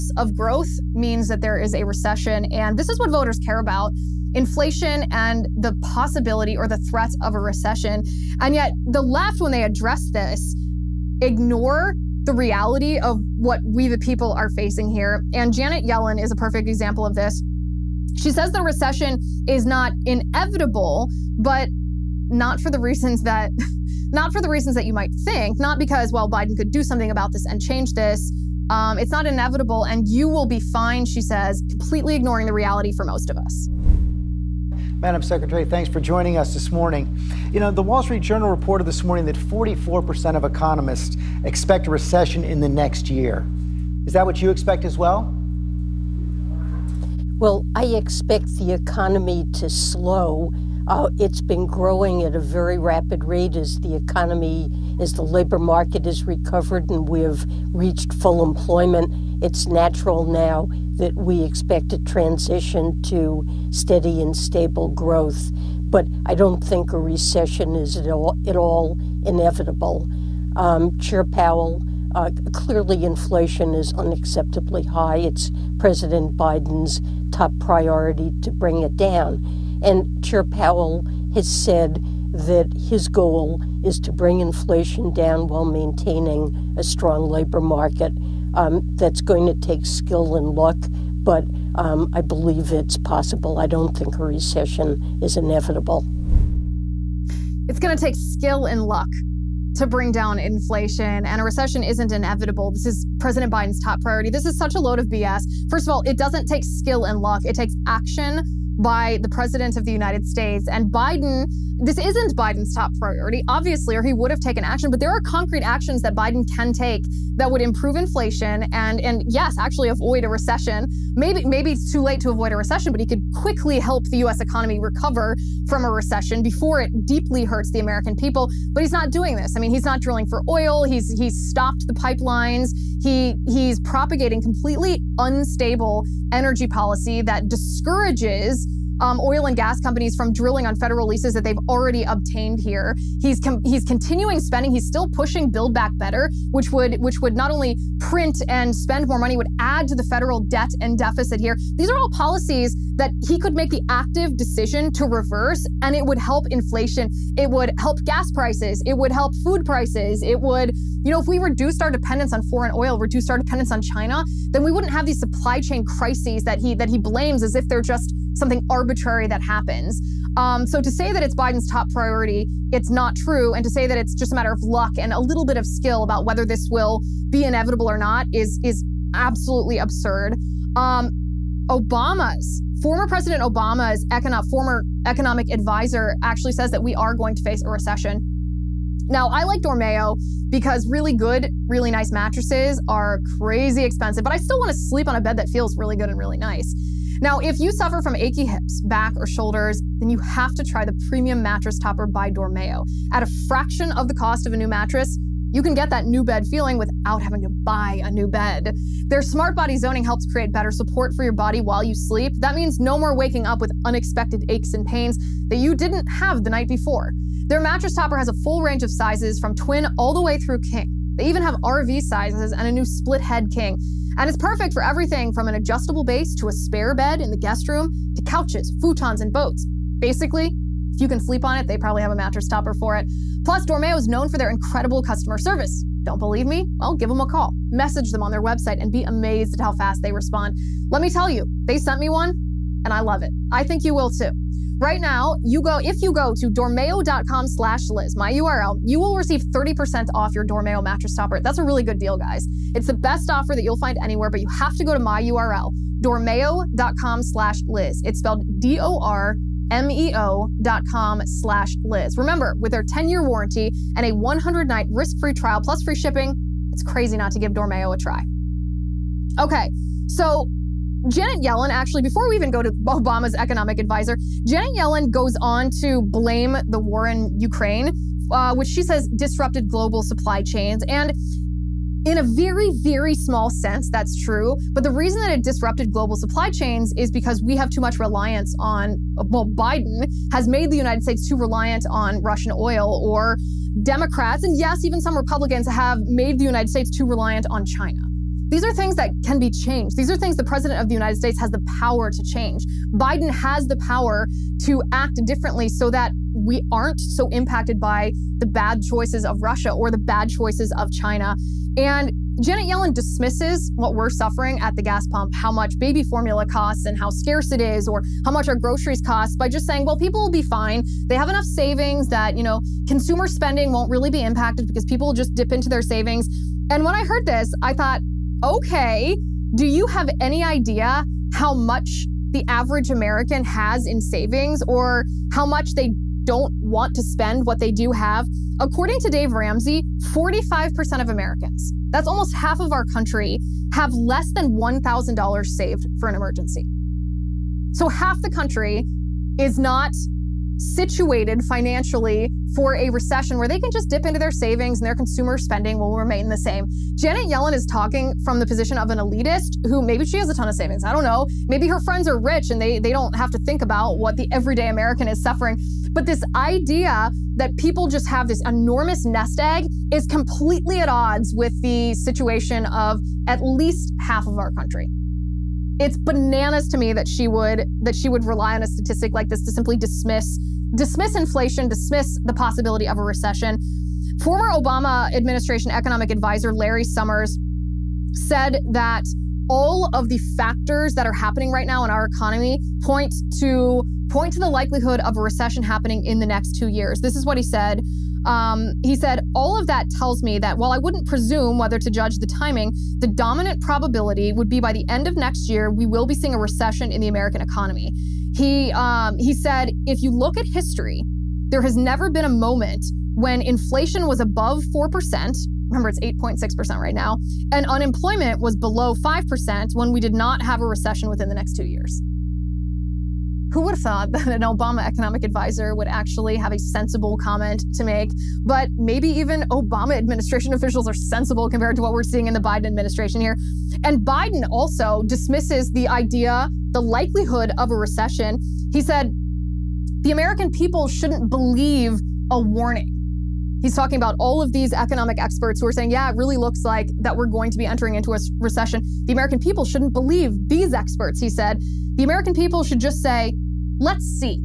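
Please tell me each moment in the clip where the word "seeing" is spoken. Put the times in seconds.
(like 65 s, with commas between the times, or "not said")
406 s, 432 s.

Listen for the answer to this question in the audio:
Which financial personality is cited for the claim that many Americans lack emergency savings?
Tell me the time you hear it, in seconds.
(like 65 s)
339 s.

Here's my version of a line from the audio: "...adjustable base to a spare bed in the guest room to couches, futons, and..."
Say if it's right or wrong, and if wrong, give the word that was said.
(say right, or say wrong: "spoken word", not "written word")
right.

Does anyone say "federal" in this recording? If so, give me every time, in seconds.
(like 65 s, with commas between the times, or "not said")
140 s, 150 s.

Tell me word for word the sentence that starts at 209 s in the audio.
Their smart body zoning helps create better support for your body while you sleep.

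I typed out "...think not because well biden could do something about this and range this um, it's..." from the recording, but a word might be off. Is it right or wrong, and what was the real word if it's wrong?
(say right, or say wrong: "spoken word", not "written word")
wrong: "change", not "range".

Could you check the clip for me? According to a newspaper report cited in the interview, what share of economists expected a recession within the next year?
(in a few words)
44%.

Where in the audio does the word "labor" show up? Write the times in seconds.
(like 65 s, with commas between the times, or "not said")
55 s, 87 s.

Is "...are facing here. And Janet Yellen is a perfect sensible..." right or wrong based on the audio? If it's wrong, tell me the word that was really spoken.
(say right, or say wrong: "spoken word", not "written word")
wrong: "example", not "sensible".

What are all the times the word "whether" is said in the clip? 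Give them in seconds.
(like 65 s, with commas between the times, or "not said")
176 s, 401 s.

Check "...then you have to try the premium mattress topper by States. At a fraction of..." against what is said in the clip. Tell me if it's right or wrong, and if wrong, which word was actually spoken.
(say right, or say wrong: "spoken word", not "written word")
wrong: "Dormeo", not "States".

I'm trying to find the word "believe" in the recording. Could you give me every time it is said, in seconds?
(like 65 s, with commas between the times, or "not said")
92 s, 236 s, 441 s, 449 s.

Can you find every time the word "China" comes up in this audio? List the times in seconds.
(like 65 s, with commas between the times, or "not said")
163 s, 297 s, 310 s.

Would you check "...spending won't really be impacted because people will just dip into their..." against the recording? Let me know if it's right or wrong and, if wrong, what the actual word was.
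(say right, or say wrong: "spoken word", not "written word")
right.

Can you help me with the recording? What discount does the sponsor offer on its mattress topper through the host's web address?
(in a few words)
30%.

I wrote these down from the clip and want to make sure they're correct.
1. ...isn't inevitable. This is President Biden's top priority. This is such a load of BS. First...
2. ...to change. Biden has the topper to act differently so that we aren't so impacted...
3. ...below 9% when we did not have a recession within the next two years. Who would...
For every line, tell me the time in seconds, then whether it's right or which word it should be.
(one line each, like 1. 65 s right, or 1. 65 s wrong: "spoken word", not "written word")
1. 101 s right
2. 302 s wrong: "power", not "topper"
3. 418 s wrong: "5", not "9".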